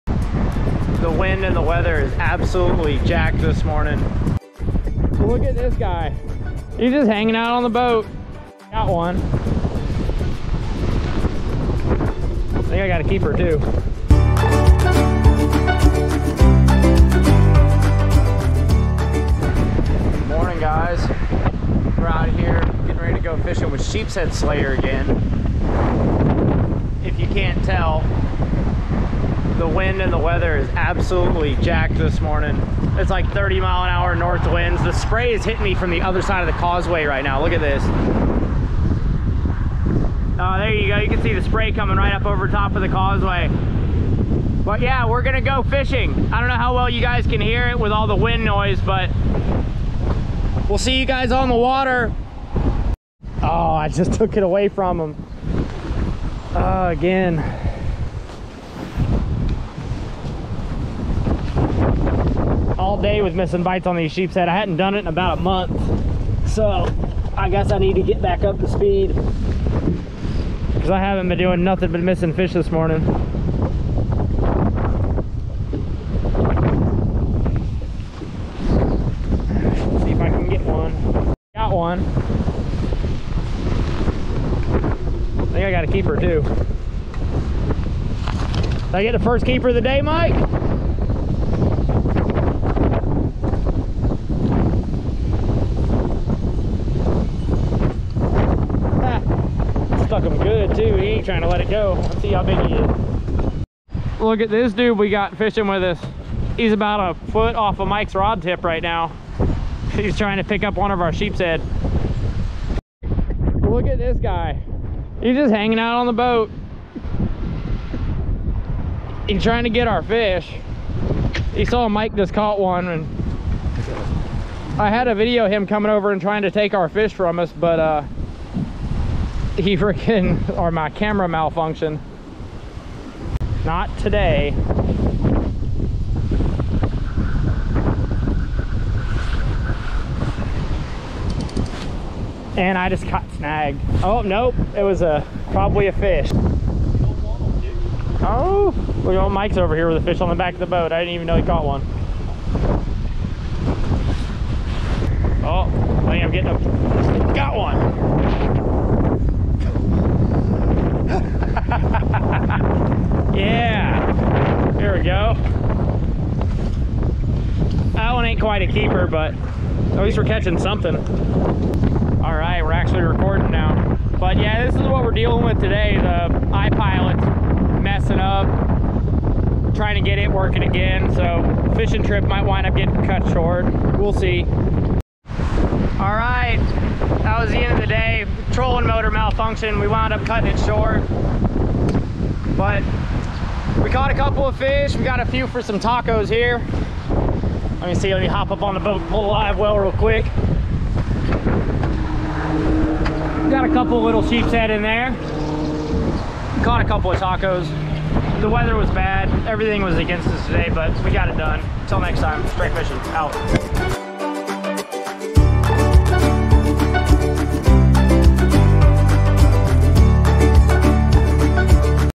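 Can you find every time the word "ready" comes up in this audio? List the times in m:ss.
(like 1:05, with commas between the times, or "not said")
0:22.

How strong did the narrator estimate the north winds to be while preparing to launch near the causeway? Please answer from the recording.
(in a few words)
30 mph.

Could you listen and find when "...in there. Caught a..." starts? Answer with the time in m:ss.
3:24.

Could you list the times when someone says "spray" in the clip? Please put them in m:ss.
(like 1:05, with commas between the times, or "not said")
0:34, 0:41.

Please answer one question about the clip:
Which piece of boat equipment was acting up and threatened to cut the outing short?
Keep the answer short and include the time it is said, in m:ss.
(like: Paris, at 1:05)
iPilot, at 2:56.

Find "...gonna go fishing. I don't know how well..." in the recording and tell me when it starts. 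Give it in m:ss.
0:45.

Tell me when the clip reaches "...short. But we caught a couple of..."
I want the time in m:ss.
3:10.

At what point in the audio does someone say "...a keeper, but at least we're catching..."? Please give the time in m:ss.
2:48.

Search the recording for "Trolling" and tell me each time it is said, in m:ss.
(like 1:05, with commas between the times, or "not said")
3:08.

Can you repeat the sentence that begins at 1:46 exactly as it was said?
He's about a foot off of Mike's rod tip right now.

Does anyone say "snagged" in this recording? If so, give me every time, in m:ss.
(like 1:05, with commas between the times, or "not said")
2:23.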